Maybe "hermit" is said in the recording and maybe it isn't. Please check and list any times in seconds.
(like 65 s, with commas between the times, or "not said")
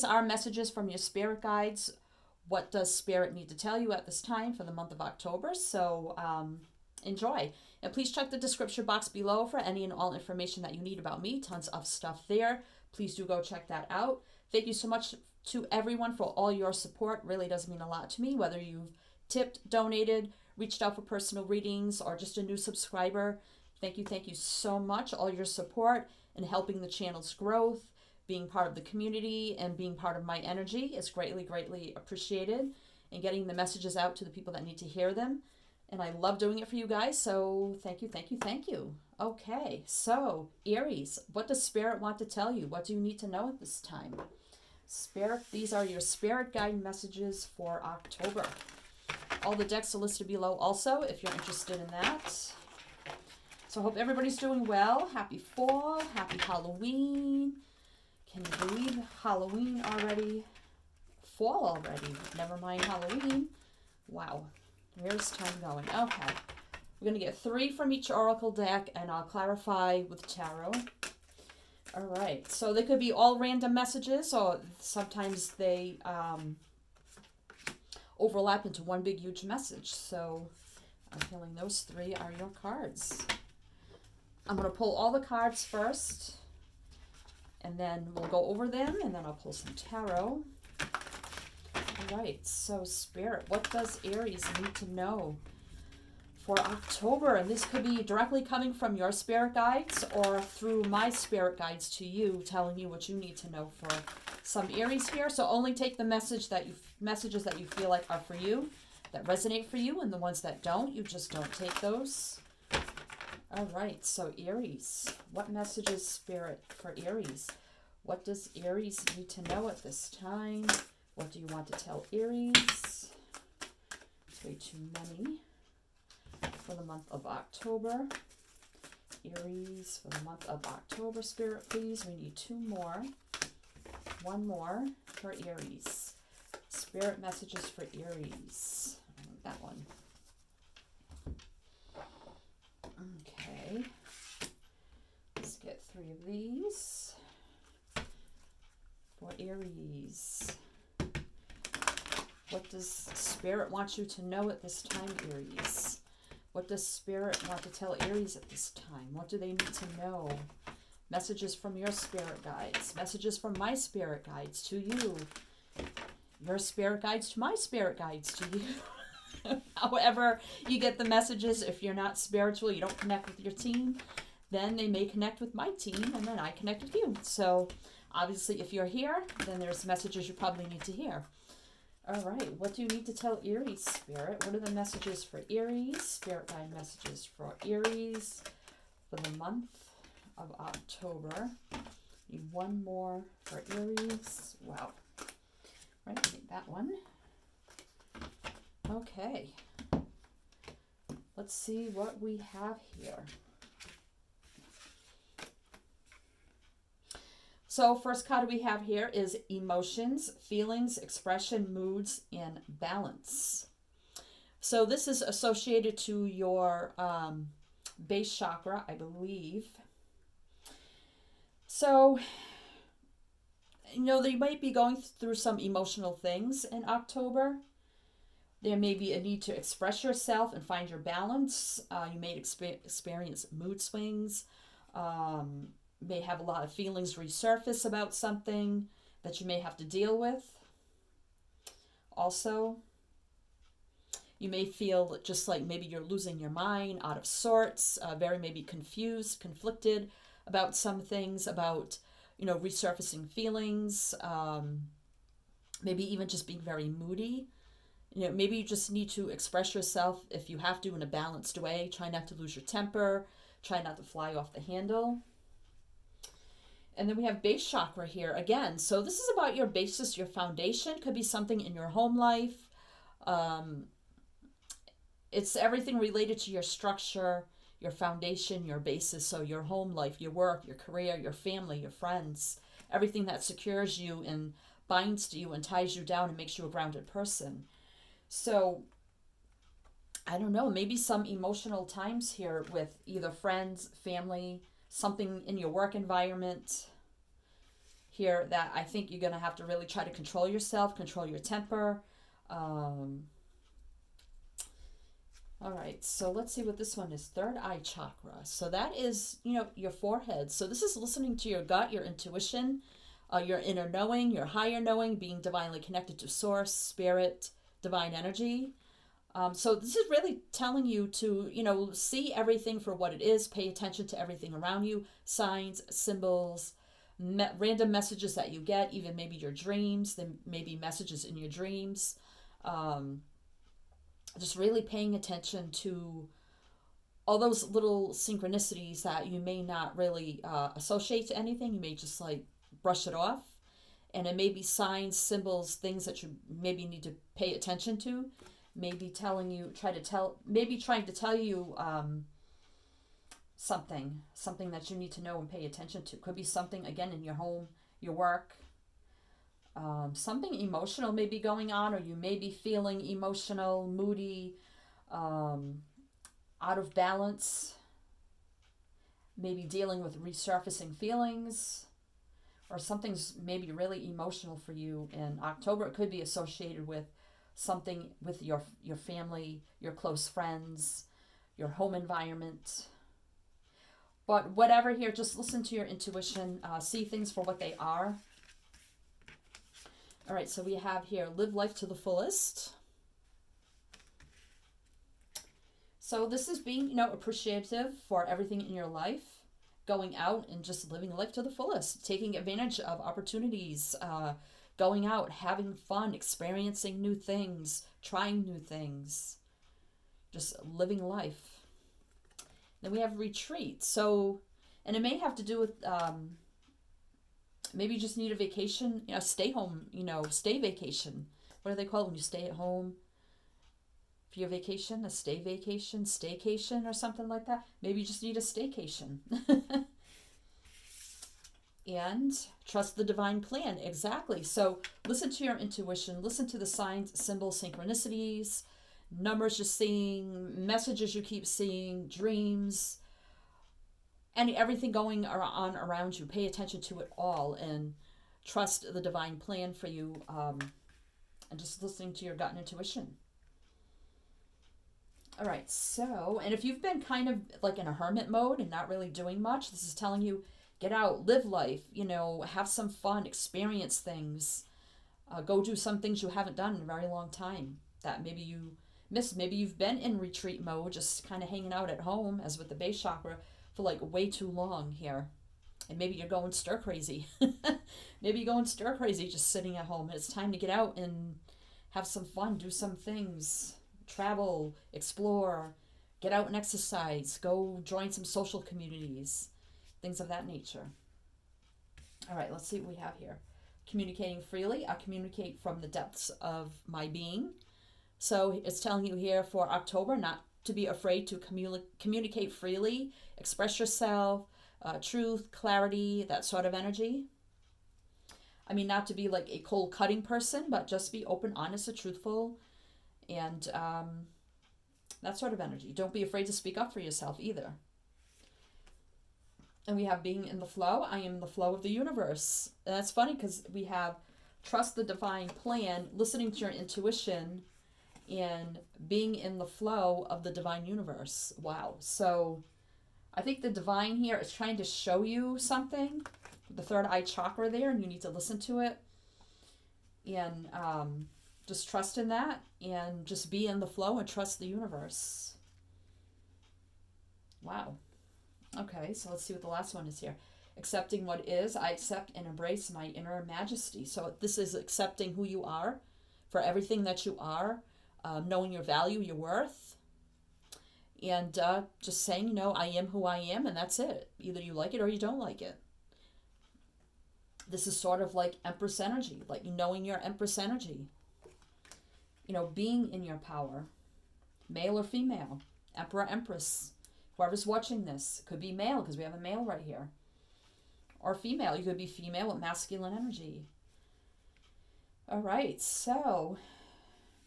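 457 s.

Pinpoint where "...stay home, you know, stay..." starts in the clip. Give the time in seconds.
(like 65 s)
419 s.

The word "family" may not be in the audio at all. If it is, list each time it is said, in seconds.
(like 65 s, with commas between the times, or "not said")
281 s, 294 s, 378 s.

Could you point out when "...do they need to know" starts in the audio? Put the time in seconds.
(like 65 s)
159 s.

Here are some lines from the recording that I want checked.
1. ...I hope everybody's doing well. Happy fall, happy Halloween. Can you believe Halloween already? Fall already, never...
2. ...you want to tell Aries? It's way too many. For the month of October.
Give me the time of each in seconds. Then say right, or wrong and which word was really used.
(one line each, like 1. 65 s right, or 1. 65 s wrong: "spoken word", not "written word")
1. 53 s right
2. 121 s right.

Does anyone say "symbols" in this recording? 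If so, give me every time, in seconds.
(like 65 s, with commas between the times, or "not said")
325 s, 345 s, 437 s.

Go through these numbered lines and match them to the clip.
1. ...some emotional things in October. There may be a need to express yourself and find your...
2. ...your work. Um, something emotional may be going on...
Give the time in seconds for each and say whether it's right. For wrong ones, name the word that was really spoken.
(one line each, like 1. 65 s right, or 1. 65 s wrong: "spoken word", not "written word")
1. 225 s right
2. 357 s right.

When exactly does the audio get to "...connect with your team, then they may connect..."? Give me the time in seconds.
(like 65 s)
172 s.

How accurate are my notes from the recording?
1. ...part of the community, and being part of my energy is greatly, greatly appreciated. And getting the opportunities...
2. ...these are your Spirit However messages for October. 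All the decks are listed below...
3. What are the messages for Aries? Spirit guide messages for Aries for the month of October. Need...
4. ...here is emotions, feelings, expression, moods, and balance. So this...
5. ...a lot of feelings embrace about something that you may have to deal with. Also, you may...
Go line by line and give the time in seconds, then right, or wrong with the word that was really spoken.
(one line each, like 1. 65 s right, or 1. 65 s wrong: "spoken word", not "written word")
1. 28 s wrong: "messages", not "opportunities"
2. 45 s wrong: "Guide", not "However"
3. 184 s right
4. 208 s right
5. 236 s wrong: "resurface", not "embrace".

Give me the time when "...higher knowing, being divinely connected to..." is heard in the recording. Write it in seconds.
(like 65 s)
314 s.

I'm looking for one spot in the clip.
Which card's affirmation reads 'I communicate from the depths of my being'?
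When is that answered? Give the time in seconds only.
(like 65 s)
493 s.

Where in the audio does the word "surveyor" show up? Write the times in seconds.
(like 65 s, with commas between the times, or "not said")
not said.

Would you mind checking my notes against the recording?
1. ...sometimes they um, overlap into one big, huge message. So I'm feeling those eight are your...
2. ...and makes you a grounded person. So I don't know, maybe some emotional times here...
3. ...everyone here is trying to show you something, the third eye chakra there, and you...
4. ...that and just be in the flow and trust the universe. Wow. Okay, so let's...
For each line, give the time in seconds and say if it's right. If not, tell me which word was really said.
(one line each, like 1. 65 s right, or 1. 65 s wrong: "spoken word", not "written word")
1. 74 s wrong: "three", not "eight"
2. 286 s right
3. 533 s wrong: "divine", not "everyone"
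4. 542 s right.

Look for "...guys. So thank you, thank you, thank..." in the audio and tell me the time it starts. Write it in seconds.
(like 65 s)
36 s.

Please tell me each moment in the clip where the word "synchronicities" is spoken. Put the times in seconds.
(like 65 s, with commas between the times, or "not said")
338 s, 437 s.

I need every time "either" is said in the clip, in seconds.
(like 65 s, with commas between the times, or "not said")
293 s, 517 s, 564 s.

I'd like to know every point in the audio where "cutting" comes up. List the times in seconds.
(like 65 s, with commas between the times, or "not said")
509 s.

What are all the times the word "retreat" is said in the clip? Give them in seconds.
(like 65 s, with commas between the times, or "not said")
413 s, 470 s.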